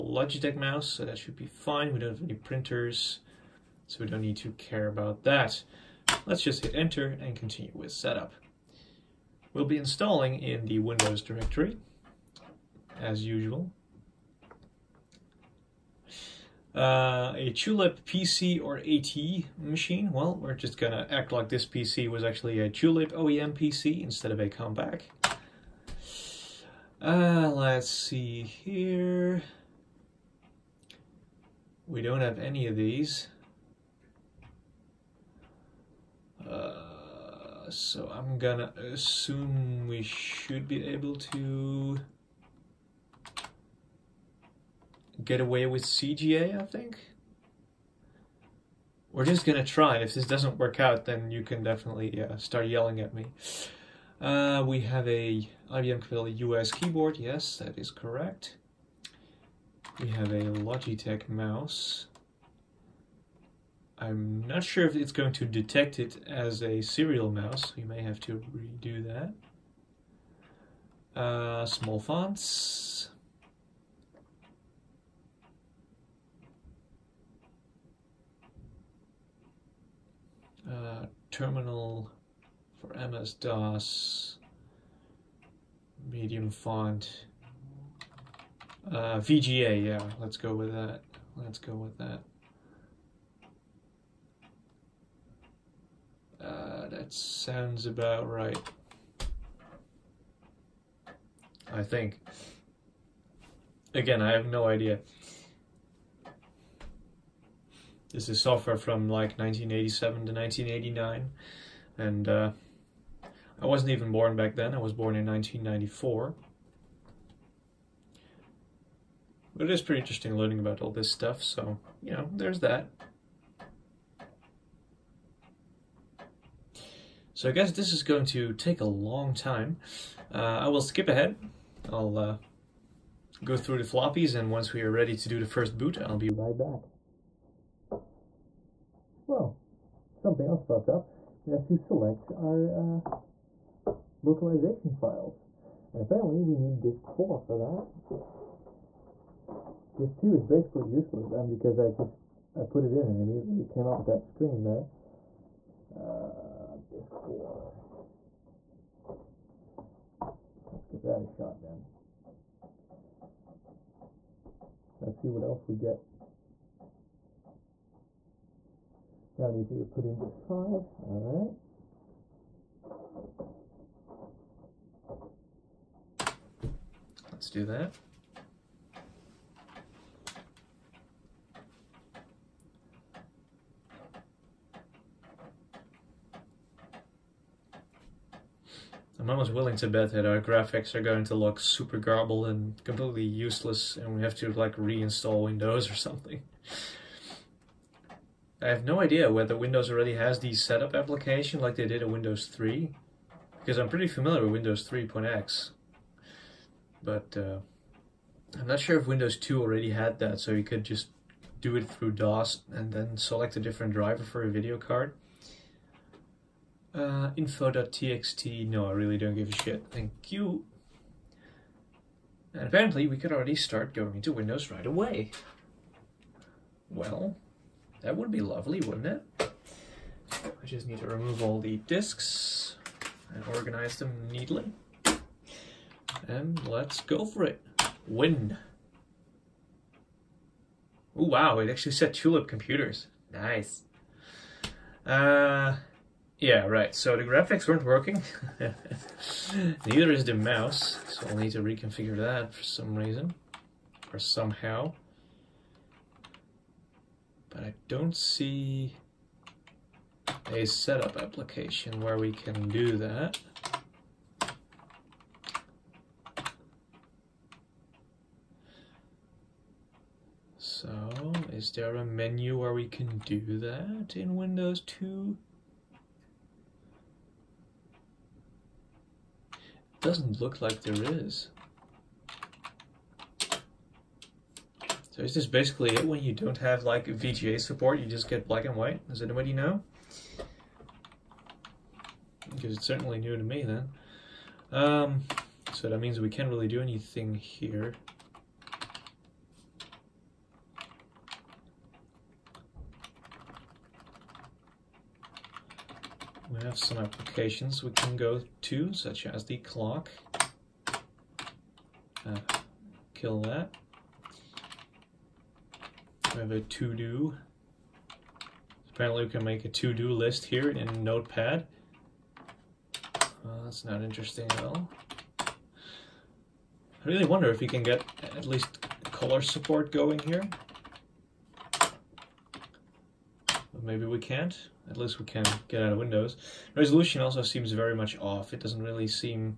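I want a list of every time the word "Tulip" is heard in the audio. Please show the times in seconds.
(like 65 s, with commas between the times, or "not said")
17 s, 22 s, 242 s.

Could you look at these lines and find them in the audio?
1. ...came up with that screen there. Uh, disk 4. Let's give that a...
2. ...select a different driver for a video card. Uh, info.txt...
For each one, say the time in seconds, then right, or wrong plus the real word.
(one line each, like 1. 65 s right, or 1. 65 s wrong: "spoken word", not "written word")
1. 153 s right
2. 213 s right.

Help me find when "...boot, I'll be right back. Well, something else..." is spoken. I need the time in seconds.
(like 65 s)
135 s.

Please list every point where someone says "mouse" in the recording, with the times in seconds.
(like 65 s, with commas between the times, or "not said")
0 s, 61 s, 67 s, 250 s.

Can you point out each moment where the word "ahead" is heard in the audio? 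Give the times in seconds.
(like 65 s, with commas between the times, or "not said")
131 s.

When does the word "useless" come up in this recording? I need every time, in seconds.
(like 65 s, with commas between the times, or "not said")
150 s, 193 s.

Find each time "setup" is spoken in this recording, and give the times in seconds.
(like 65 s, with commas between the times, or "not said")
7 s, 200 s, 260 s.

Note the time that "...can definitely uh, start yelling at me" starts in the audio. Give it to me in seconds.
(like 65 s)
51 s.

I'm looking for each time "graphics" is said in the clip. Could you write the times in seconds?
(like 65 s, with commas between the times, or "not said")
190 s, 247 s.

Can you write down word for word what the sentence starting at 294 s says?
Um, so that means we can't really do anything here.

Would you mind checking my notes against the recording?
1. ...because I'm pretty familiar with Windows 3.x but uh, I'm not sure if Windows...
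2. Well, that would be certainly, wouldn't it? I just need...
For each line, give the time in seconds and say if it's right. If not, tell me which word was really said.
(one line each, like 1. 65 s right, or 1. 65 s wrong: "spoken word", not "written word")
1. 203 s right
2. 226 s wrong: "lovely", not "certainly".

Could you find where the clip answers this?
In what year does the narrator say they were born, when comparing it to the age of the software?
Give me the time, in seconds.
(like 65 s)
115 s.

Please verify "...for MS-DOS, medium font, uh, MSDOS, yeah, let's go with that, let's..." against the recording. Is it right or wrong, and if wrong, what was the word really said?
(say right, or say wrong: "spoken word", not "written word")
wrong: "VGA", not "MSDOS".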